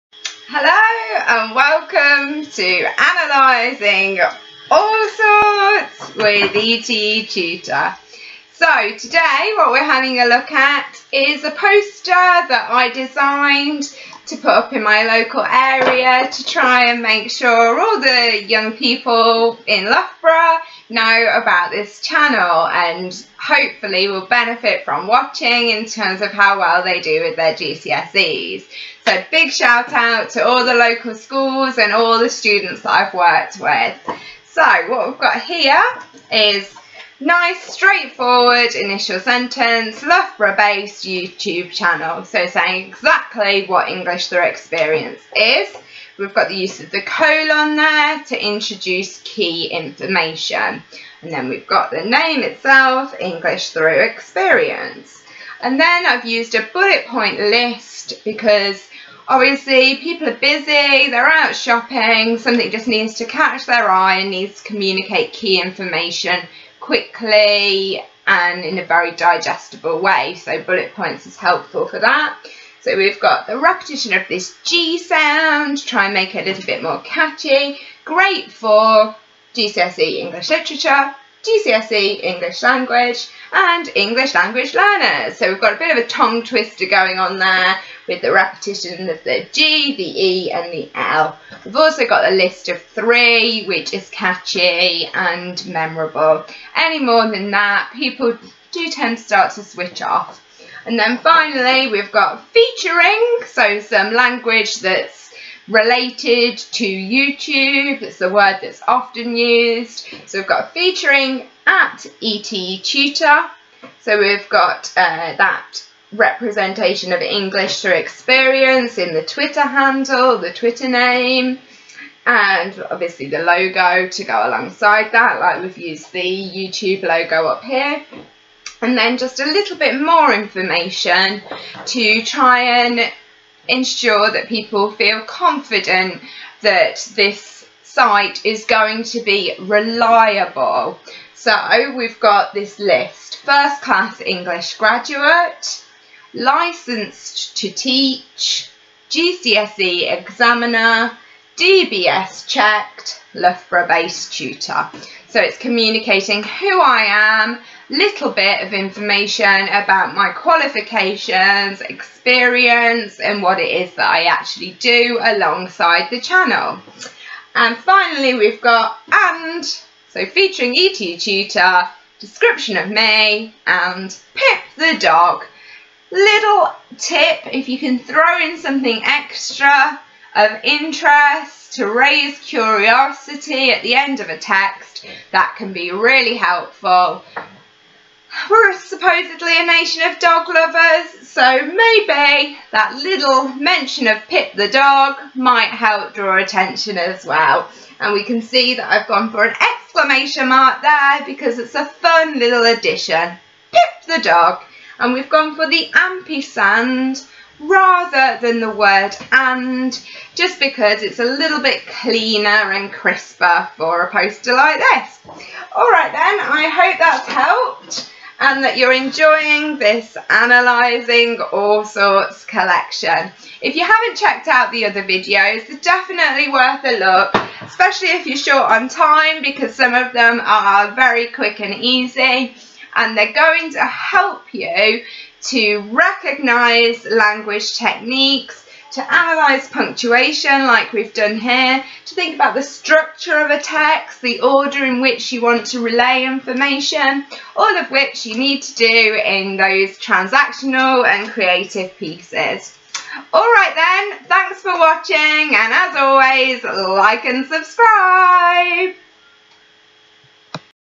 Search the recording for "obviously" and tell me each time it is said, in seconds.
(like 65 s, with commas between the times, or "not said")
59 s, 122 s.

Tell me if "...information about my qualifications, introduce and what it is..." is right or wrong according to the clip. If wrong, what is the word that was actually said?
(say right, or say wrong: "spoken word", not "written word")
wrong: "experience", not "introduce".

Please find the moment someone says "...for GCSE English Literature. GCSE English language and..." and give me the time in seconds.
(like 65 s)
78 s.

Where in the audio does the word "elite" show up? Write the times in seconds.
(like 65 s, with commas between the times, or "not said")
not said.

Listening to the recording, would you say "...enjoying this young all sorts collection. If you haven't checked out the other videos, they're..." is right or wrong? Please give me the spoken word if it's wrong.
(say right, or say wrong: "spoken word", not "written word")
wrong: "analysing", not "young".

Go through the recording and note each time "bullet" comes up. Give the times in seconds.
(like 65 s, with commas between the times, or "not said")
56 s, 70 s.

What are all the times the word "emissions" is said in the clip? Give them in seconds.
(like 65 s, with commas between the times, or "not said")
not said.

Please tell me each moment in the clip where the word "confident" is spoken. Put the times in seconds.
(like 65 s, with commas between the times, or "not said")
135 s.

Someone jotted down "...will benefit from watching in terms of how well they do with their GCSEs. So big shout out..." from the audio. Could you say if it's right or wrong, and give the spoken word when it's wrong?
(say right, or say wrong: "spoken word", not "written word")
right.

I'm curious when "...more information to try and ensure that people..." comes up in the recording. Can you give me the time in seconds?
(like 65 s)
130 s.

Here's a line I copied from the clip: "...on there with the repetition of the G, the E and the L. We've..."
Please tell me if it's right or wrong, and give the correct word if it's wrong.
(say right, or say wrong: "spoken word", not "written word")
right.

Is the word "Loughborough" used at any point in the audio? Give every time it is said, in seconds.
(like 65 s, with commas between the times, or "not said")
19 s, 40 s, 153 s.